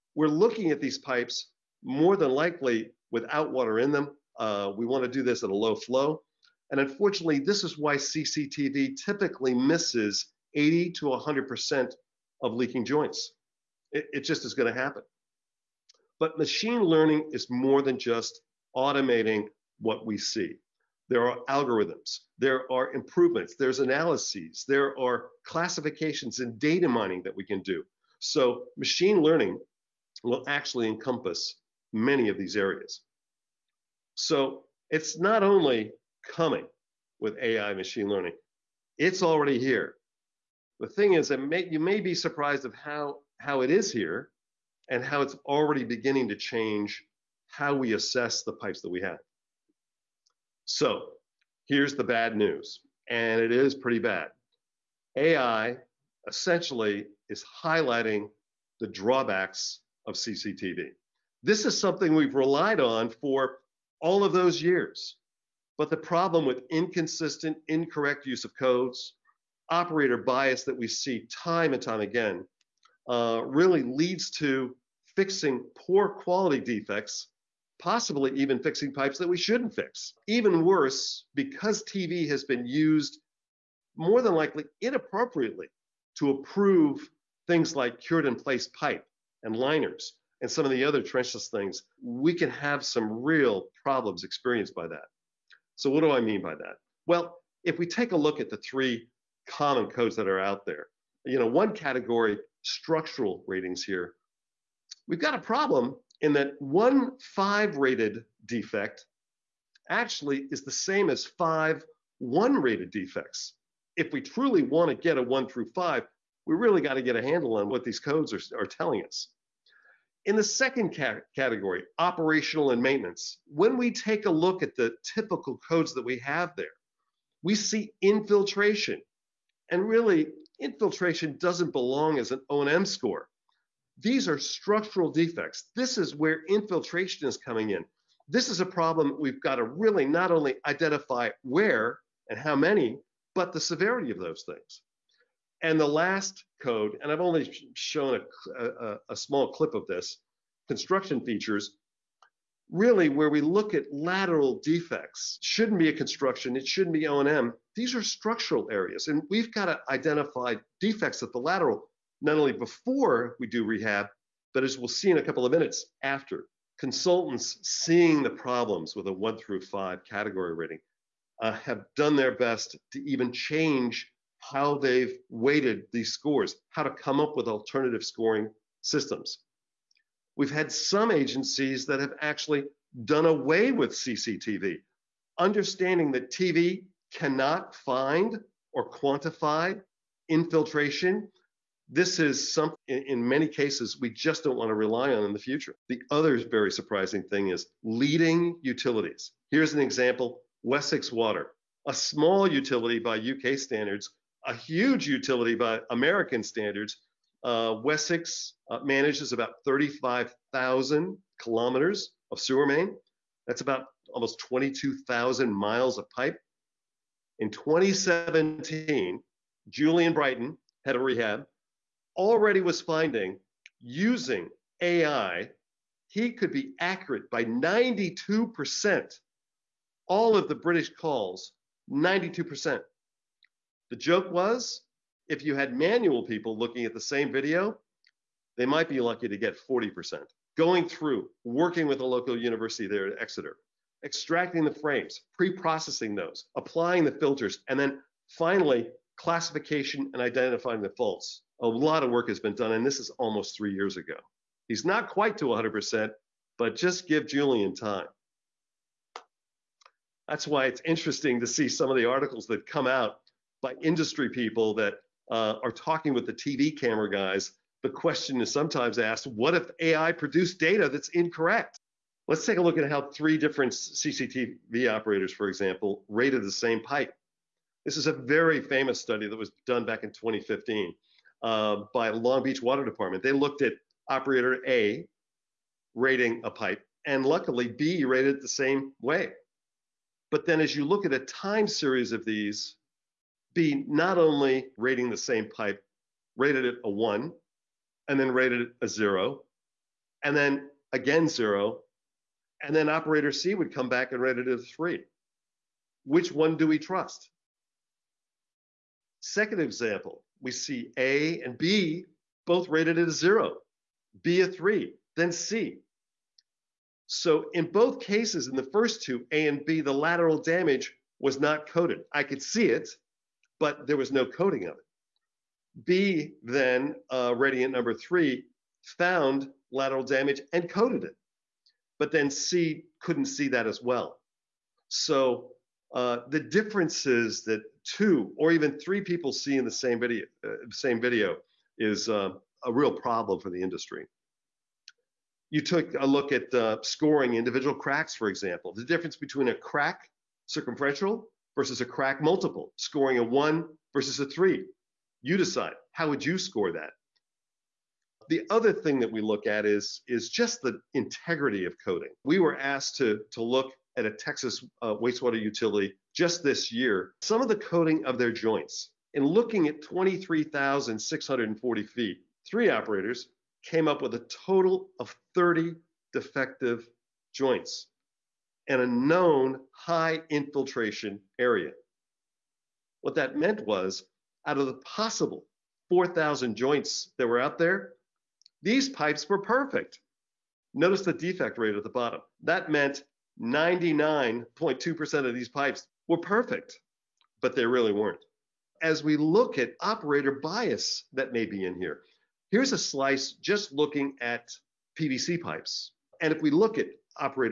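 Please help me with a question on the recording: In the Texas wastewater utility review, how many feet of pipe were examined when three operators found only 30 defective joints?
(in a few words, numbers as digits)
23,640.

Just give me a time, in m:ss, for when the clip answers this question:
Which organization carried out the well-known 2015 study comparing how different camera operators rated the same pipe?
4:42.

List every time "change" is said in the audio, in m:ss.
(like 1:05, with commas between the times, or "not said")
0:46, 2:53.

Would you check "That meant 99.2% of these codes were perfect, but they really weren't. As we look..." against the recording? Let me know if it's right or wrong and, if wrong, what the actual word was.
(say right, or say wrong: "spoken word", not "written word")
wrong: "pipes", not "codes".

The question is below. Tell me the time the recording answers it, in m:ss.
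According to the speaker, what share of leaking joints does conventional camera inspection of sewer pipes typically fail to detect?
0:10.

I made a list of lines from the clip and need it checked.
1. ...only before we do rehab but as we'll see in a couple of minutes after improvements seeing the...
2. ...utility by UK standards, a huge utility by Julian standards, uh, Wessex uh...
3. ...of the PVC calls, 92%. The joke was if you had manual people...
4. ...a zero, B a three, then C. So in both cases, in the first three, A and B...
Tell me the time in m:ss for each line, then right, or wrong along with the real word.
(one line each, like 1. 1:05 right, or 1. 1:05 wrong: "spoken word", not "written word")
1. 2:42 wrong: "consultants", not "improvements"
2. 3:22 wrong: "American", not "Julian"
3. 3:50 wrong: "British", not "PVC"
4. 5:13 wrong: "two", not "three".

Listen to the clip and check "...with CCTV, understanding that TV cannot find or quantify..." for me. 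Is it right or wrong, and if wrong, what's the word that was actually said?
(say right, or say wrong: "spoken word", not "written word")
right.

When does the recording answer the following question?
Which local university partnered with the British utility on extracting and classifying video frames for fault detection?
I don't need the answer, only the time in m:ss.
4:03.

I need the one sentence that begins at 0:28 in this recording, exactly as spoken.
So machine learning will actually encompass many of these areas.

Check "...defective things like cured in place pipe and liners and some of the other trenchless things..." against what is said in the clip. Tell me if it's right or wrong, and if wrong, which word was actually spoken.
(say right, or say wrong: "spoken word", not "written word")
wrong: "approve", not "defective".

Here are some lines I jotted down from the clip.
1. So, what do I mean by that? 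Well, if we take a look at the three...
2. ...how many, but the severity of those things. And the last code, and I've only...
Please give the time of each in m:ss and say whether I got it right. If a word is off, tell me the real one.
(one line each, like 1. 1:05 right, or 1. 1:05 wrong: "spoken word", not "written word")
1. 1:35 right
2. 2:22 right.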